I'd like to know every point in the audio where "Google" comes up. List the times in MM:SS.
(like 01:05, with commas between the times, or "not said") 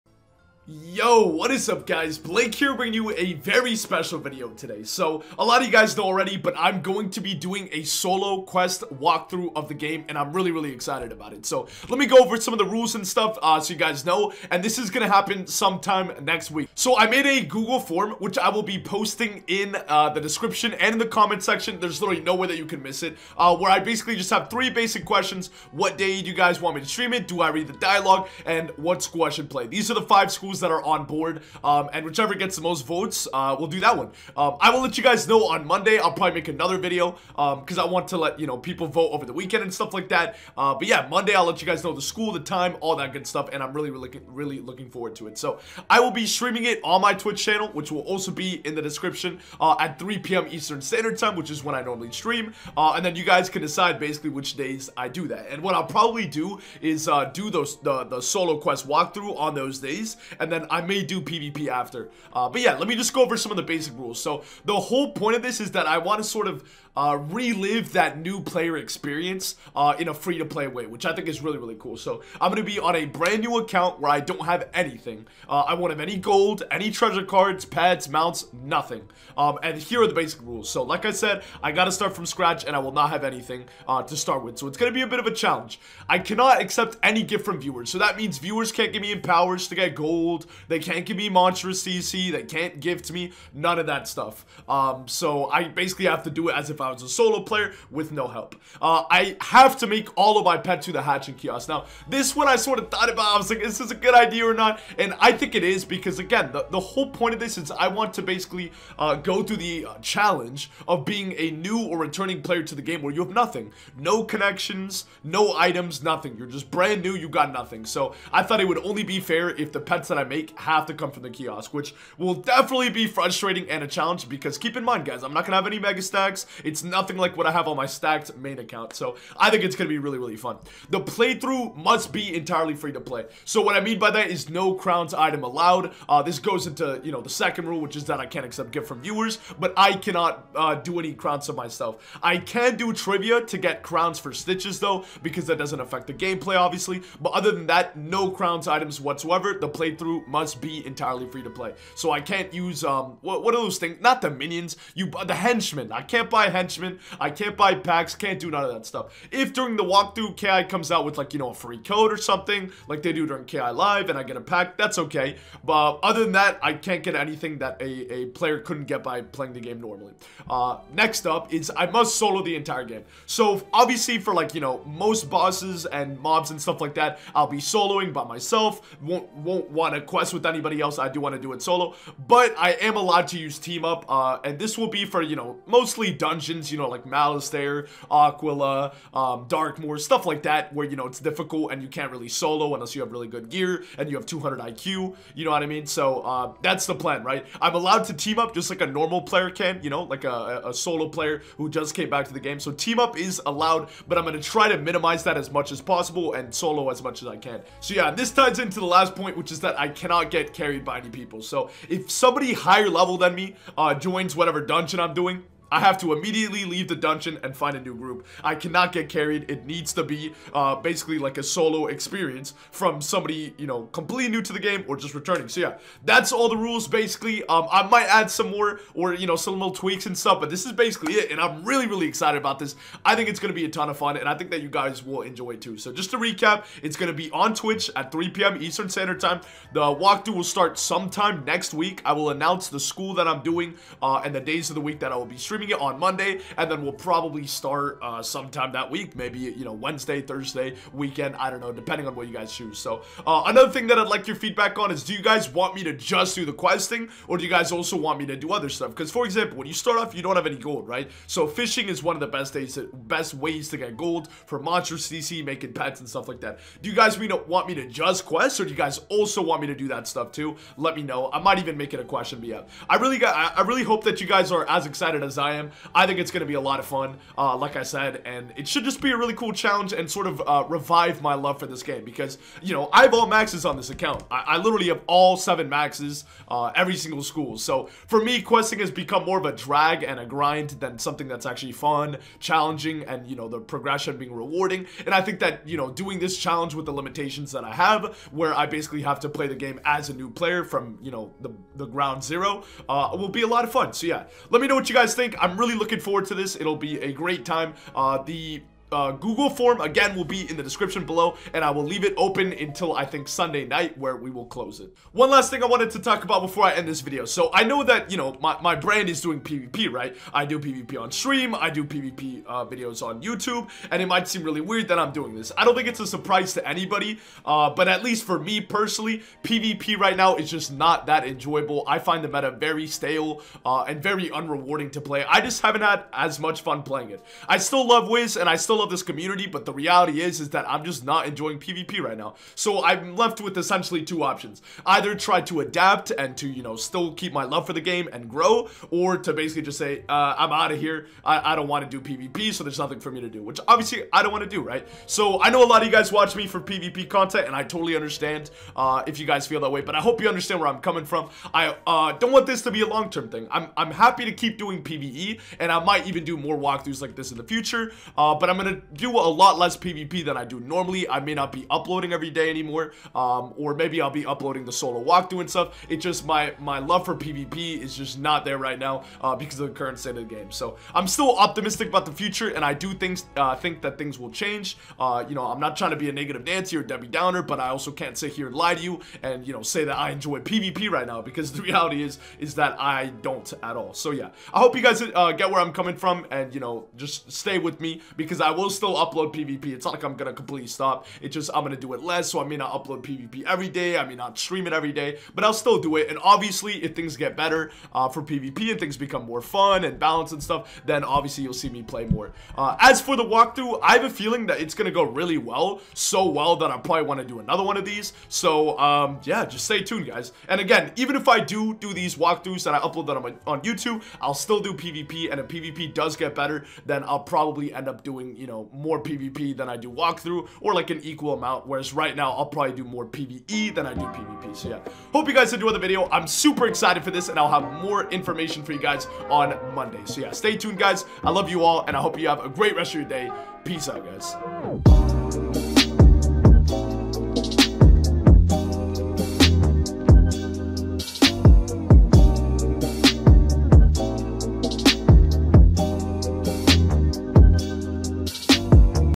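00:17, 05:09.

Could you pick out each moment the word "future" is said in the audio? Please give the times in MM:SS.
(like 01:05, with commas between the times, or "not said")
06:07, 06:22.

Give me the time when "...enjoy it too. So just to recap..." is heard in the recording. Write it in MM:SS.
03:55.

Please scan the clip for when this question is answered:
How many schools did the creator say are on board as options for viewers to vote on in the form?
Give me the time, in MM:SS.
00:30.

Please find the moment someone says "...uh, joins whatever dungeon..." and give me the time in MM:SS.
03:33.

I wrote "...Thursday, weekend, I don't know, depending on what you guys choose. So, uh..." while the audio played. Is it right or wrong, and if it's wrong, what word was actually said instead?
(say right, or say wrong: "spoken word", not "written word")
right.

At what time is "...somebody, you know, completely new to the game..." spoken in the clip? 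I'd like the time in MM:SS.
03:43.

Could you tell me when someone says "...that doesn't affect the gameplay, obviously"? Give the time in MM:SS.
02:25.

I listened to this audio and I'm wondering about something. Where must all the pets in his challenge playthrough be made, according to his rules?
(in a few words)
hatching kiosk.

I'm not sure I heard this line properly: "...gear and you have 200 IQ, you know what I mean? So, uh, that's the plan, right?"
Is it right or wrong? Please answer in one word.
right.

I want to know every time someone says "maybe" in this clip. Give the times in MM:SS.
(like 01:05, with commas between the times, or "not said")
04:09, 06:13.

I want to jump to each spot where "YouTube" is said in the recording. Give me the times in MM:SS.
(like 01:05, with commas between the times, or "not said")
05:23, 07:03.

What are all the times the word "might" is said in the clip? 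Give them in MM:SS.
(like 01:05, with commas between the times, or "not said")
03:47, 04:31, 05:24, 06:05.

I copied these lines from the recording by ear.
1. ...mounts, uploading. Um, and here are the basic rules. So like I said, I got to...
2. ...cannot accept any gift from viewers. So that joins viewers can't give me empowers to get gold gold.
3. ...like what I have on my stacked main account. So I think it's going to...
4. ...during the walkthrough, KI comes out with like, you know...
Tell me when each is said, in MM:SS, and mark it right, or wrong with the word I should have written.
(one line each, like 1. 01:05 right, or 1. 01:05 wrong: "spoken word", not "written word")
1. 01:18 wrong: "nothing", not "uploading"
2. 01:26 wrong: "means", not "joins"
3. 02:07 right
4. 02:39 right.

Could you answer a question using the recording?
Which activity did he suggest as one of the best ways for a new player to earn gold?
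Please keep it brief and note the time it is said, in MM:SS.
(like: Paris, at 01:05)
fishing, at 04:21.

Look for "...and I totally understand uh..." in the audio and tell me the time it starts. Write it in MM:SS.
05:57.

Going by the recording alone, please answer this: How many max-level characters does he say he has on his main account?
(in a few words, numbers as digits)
7.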